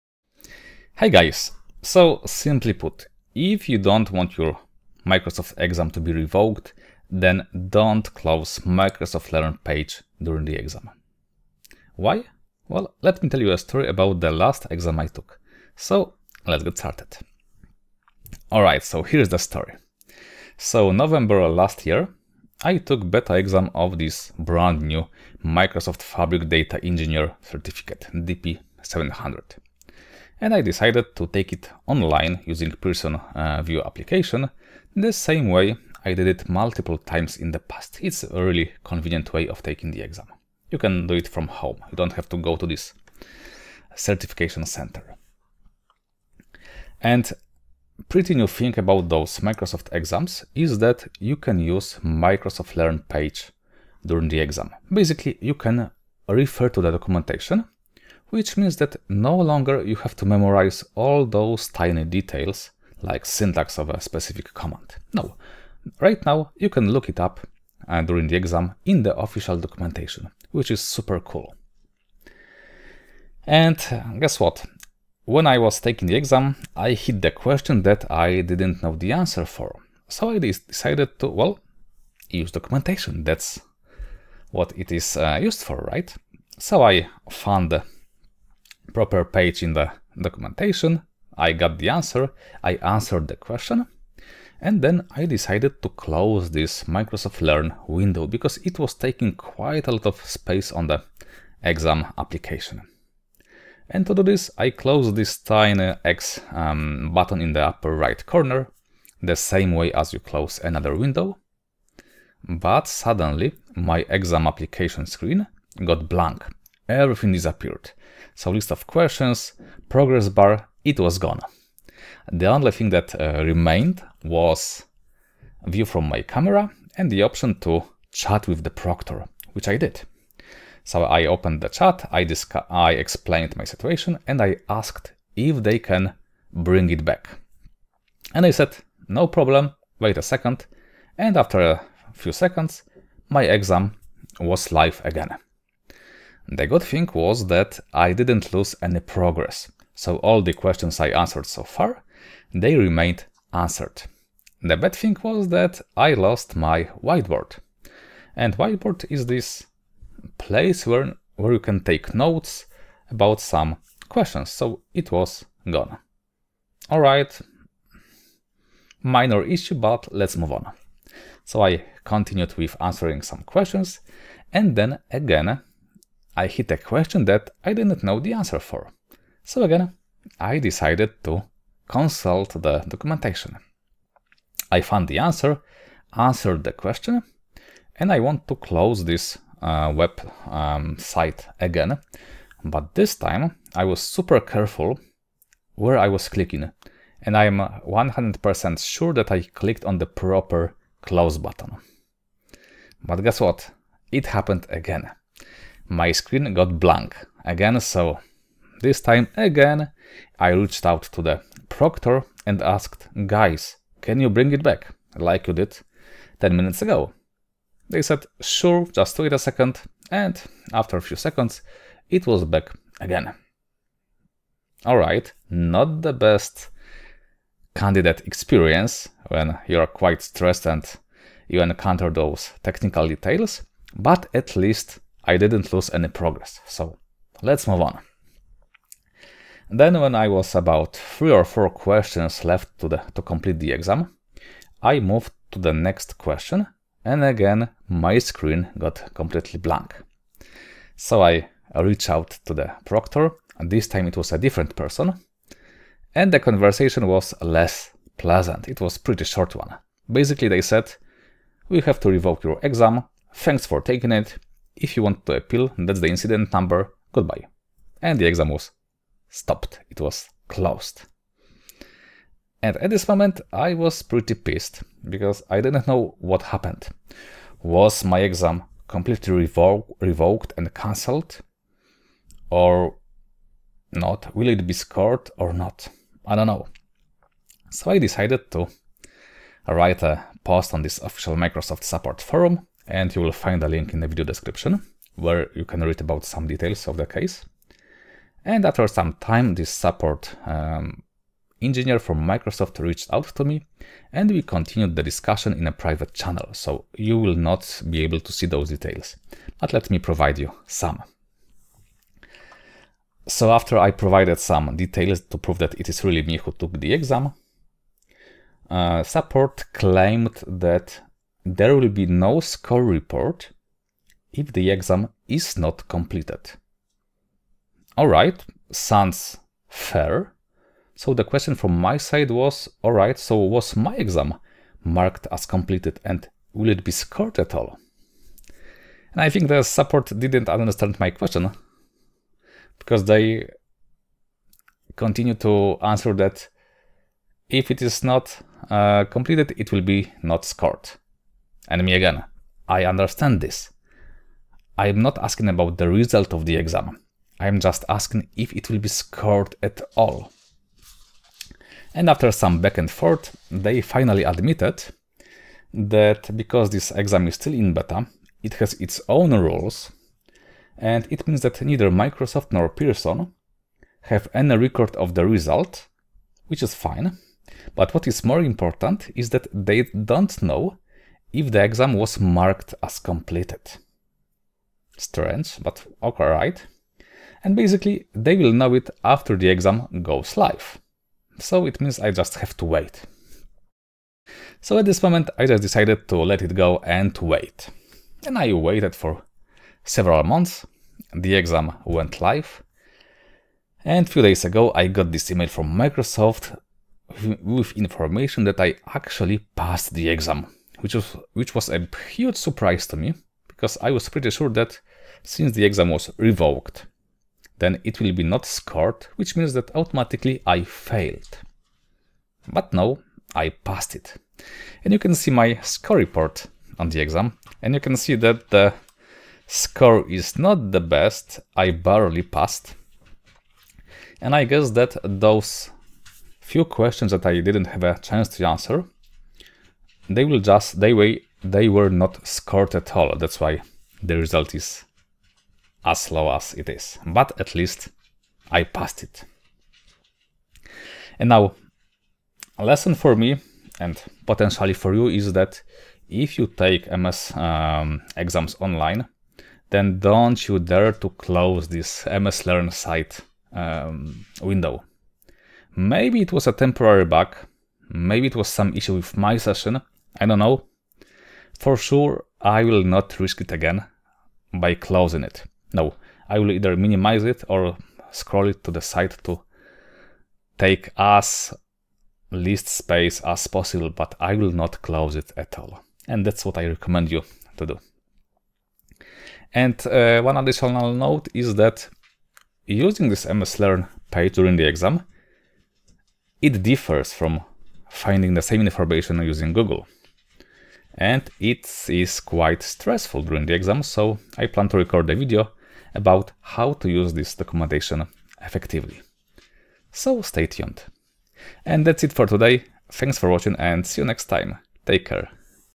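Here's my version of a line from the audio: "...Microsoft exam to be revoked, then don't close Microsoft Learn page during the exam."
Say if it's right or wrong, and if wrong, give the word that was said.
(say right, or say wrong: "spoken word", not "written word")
right.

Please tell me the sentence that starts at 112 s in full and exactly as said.
But suddenly, my exam application screen got blank everything disappeared.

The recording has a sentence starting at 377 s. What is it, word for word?
But what is more important is that they don't know if the exam was marked as completed.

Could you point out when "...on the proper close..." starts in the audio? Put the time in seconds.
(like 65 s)
199 s.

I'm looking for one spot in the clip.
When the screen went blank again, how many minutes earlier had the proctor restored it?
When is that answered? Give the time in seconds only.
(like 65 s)
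216 s.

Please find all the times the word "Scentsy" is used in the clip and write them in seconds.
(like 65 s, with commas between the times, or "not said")
not said.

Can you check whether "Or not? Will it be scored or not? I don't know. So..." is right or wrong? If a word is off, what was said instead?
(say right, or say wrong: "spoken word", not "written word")
right.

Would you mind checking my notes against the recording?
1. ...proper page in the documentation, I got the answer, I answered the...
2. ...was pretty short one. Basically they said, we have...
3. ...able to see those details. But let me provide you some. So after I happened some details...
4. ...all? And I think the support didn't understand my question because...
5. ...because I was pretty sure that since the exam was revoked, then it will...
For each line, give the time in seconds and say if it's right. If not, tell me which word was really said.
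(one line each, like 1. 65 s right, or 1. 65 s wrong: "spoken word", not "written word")
1. 88 s right
2. 258 s right
3. 308 s wrong: "provided", not "happened"
4. 337 s right
5. 413 s right.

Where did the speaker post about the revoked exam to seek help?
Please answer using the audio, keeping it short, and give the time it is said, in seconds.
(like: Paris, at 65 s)
Microsoft support forum, at 291 s.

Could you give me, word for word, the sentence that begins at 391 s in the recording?
So it means I just have to wait.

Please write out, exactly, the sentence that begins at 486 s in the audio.
And that's what I recommend you to do.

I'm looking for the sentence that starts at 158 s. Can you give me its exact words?
And whiteboard is this place where, where you can take notes about some questions, so it was gone.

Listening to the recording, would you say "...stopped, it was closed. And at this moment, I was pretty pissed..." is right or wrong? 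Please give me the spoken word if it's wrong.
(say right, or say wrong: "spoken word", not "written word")
right.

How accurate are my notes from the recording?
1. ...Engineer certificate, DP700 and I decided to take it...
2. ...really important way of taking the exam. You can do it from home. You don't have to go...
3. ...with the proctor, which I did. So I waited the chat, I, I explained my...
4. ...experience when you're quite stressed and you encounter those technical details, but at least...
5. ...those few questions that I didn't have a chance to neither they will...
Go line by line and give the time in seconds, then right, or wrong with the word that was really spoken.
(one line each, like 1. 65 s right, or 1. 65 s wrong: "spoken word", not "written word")
1. 26 s right
2. 38 s wrong: "convenient", not "important"
3. 128 s wrong: "opened", not "waited"
4. 228 s right
5. 435 s wrong: "answer", not "neither".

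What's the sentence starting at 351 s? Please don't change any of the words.
And me again, I understand this.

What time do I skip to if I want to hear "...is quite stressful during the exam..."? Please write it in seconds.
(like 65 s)
501 s.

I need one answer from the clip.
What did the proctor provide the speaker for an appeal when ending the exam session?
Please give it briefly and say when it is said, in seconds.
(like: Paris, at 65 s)
incident number, at 266 s.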